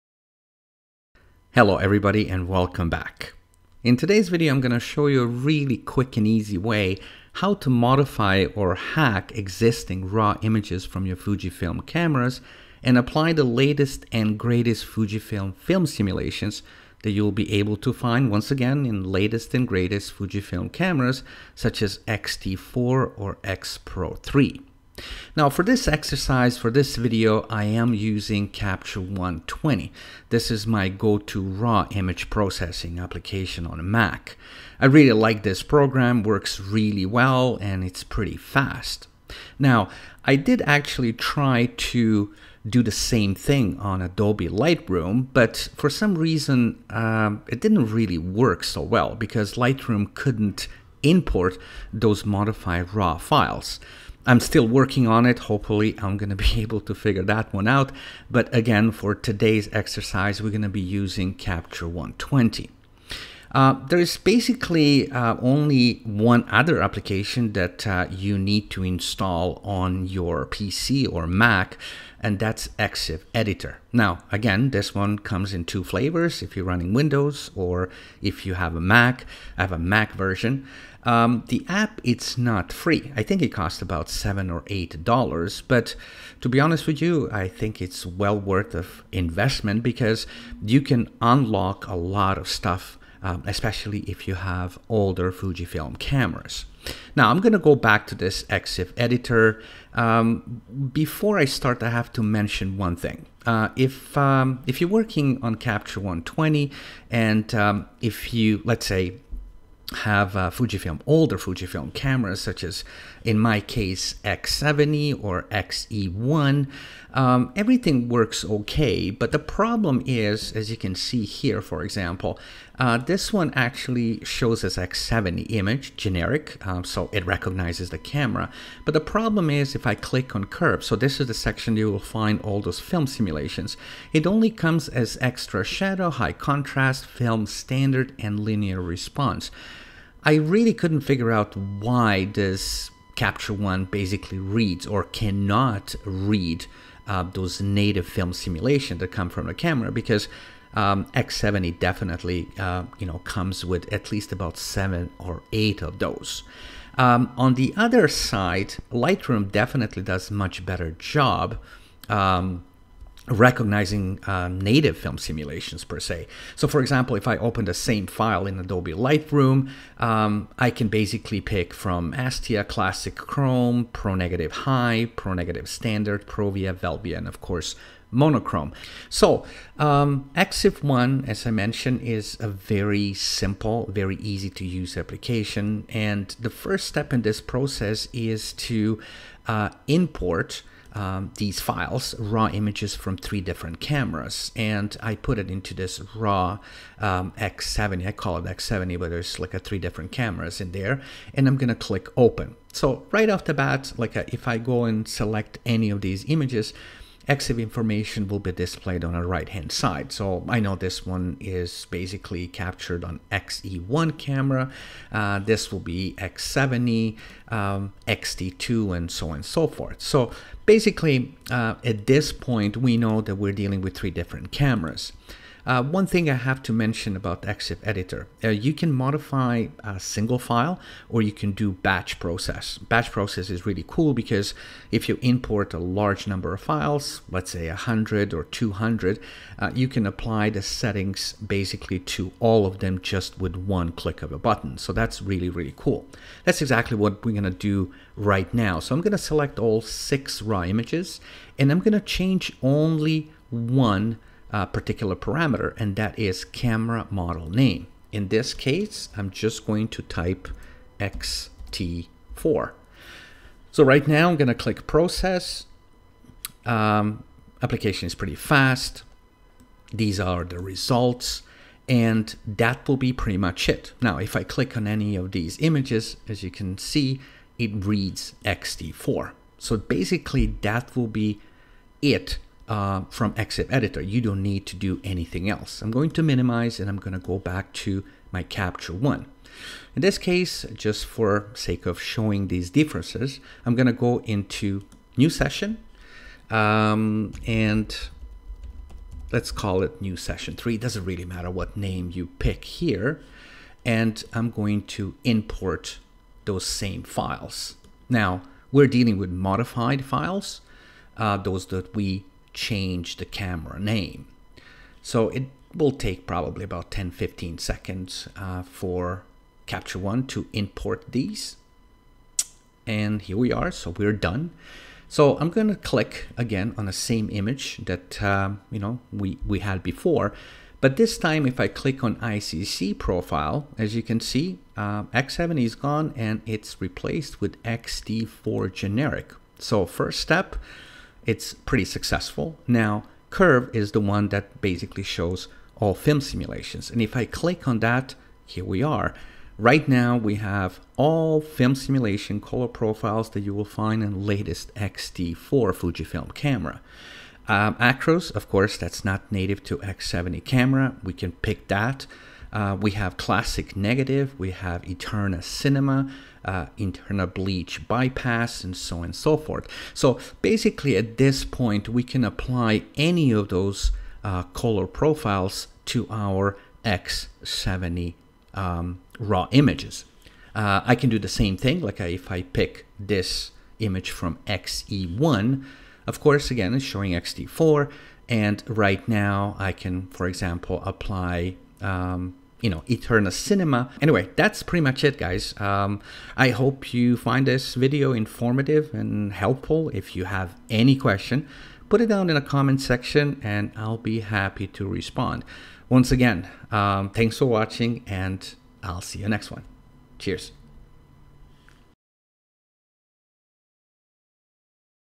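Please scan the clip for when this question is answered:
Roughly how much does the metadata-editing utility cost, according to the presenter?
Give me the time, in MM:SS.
01:24.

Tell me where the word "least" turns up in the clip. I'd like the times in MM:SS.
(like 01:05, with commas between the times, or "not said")
02:34.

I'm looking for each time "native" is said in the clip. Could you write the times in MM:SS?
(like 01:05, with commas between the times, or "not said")
02:27, 02:44, 05:59.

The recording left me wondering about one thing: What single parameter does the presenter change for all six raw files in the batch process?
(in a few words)
Camera model name.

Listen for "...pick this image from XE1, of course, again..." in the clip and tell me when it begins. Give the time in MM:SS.
06:22.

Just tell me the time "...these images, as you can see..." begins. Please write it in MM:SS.
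04:35.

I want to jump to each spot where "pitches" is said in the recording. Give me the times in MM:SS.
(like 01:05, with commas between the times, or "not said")
not said.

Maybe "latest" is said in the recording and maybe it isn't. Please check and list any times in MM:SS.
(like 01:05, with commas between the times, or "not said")
00:13, 00:19, 05:54.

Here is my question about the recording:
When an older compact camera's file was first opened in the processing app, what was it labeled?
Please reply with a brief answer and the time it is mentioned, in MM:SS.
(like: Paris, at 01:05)
X70 generic, at 02:04.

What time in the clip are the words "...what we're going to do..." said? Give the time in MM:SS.
04:06.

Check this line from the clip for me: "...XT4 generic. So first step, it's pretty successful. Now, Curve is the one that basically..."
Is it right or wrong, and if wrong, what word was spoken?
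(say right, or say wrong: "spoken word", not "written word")
right.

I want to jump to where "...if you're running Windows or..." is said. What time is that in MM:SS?
01:16.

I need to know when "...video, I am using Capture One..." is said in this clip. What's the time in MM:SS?
00:26.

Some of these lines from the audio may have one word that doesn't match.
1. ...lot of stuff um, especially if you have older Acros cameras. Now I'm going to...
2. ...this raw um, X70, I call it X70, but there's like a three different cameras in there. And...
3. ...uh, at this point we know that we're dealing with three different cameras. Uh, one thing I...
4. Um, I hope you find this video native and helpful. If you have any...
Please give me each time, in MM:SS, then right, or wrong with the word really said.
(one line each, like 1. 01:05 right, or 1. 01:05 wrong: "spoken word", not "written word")
1. 01:31 wrong: "Fujifilm", not "Acros"
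2. 03:15 right
3. 03:41 right
4. 06:35 wrong: "informative", not "native".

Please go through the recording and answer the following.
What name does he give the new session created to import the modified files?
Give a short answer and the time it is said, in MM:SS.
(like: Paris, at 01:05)
New Session 3, at 05:00.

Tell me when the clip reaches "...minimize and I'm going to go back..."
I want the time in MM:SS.
04:46.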